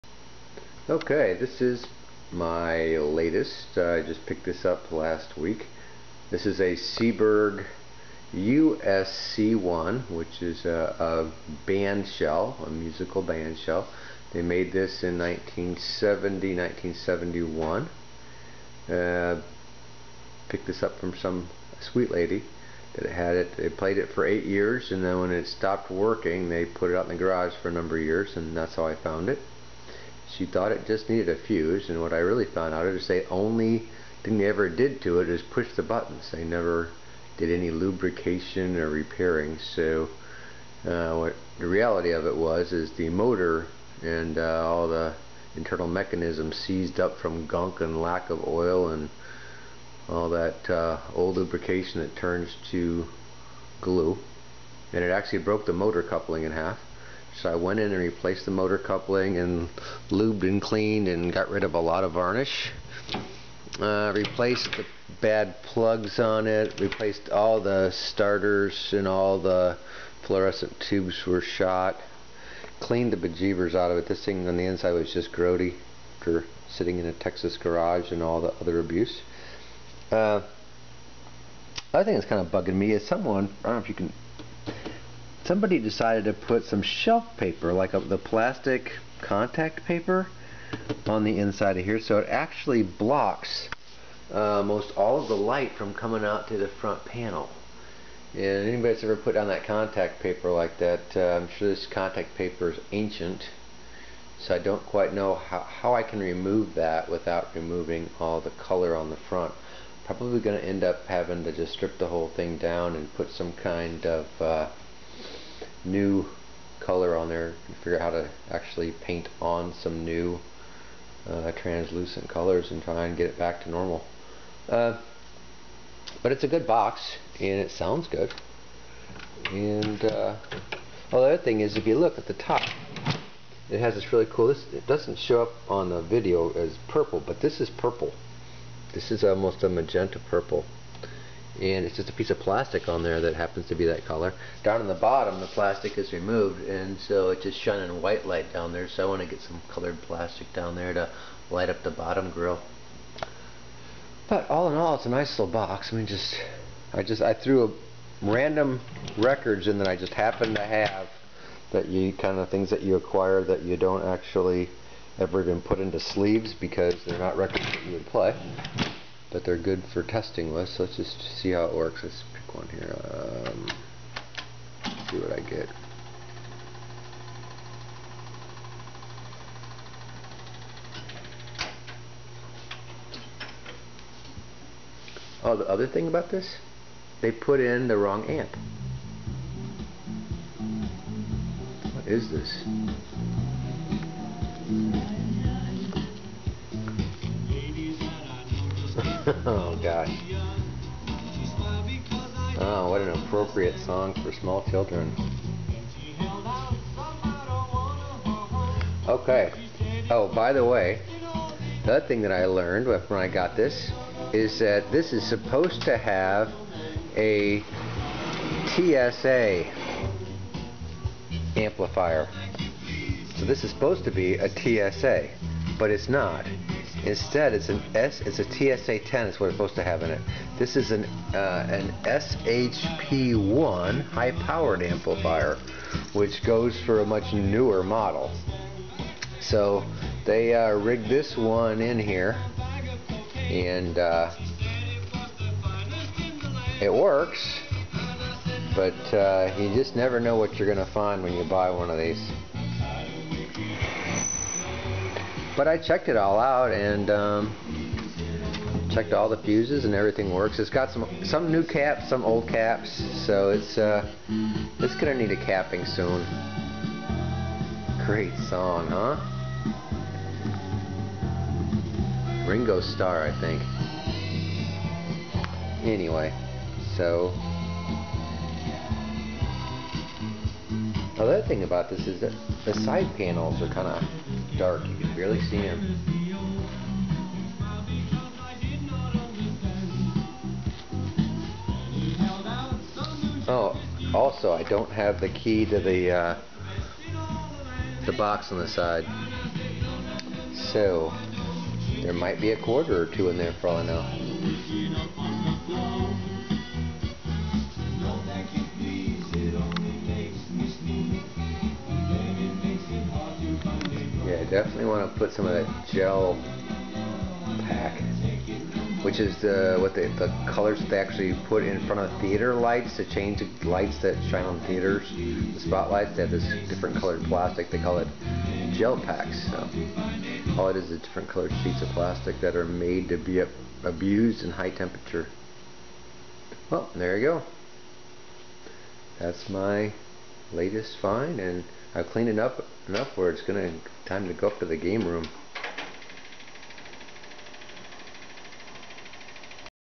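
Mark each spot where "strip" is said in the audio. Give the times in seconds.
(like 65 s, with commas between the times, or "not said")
111 s.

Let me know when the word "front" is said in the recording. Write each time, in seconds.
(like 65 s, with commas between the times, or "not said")
96 s, 109 s, 321 s.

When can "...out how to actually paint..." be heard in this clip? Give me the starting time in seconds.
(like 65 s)
117 s.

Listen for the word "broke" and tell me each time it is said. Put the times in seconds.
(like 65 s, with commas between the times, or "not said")
55 s.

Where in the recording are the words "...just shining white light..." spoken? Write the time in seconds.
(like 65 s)
147 s.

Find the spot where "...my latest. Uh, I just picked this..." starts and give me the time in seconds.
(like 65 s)
2 s.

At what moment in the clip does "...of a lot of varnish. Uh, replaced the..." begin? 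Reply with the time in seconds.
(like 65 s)
61 s.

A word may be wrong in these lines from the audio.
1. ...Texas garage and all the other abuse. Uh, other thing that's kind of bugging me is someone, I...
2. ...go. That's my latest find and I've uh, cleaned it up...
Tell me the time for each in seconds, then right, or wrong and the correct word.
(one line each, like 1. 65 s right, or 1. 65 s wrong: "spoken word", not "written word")
1. 77 s right
2. 337 s right.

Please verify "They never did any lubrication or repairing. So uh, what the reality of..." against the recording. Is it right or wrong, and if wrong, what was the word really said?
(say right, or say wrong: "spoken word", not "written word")
right.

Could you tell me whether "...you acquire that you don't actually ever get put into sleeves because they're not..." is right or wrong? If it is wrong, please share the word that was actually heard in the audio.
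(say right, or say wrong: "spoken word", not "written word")
right.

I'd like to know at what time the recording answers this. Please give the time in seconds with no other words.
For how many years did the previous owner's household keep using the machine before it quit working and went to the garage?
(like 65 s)
24 s.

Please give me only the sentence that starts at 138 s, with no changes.
This is almost a magenta purple and it's just a piece of plastic on there that happens to be that color.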